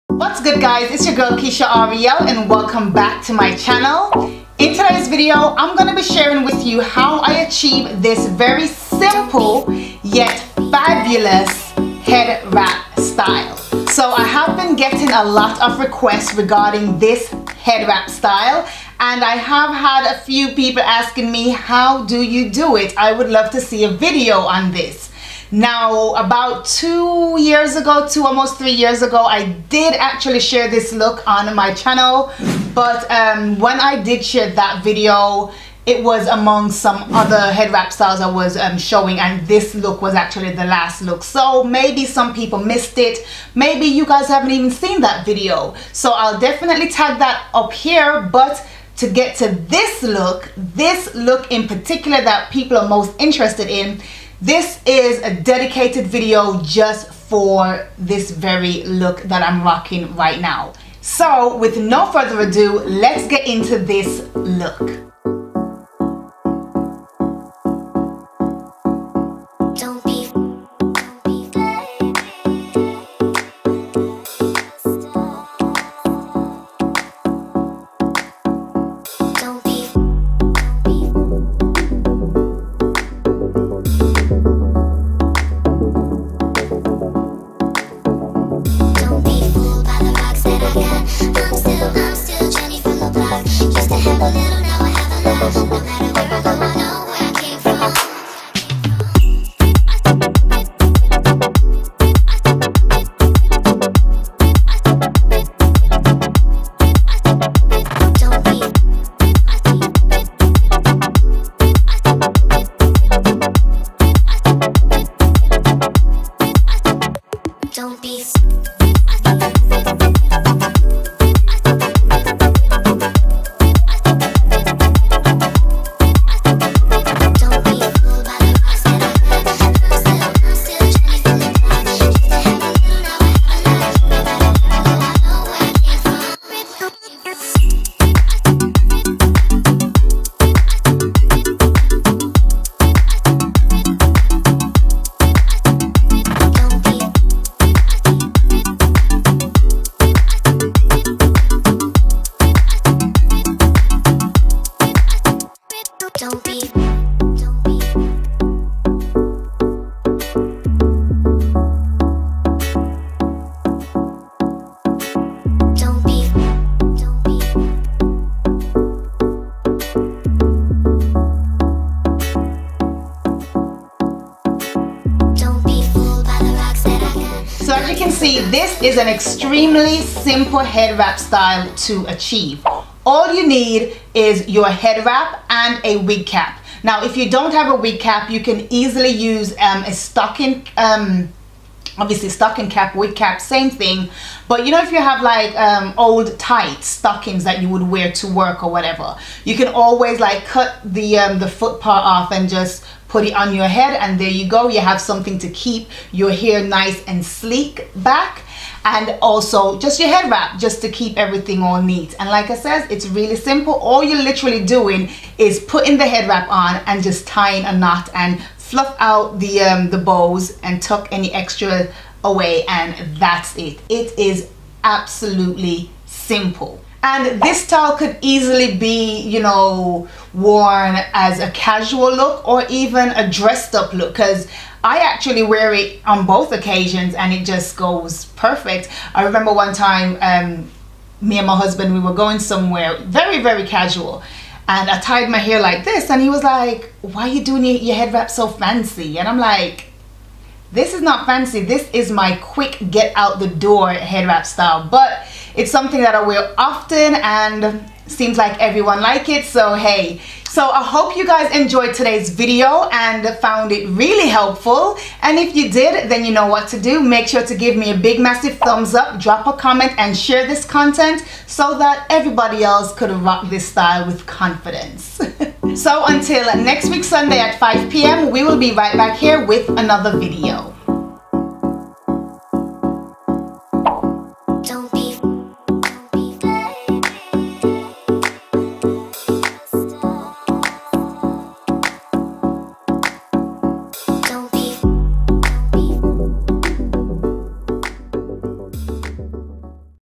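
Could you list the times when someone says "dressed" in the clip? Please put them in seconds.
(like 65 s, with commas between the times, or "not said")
233 s.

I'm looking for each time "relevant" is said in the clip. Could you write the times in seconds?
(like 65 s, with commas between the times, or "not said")
not said.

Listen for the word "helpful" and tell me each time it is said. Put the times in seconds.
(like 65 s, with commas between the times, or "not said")
264 s.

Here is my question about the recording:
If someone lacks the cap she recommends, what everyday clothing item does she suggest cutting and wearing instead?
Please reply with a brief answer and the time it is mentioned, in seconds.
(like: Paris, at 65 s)
old tight stockings, at 195 s.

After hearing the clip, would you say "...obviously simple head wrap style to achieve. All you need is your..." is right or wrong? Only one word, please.
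wrong.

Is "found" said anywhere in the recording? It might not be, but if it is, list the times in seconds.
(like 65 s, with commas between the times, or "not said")
263 s.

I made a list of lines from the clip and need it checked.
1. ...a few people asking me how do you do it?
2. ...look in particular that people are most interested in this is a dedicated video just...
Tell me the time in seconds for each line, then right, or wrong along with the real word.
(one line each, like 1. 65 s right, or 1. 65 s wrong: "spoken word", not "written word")
1. 20 s right
2. 51 s right.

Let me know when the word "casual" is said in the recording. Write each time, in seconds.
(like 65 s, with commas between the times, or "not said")
231 s, 243 s.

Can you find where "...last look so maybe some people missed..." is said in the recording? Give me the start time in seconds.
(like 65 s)
40 s.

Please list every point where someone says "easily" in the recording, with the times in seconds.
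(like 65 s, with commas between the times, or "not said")
188 s, 228 s.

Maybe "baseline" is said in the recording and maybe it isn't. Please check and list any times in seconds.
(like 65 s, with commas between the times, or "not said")
not said.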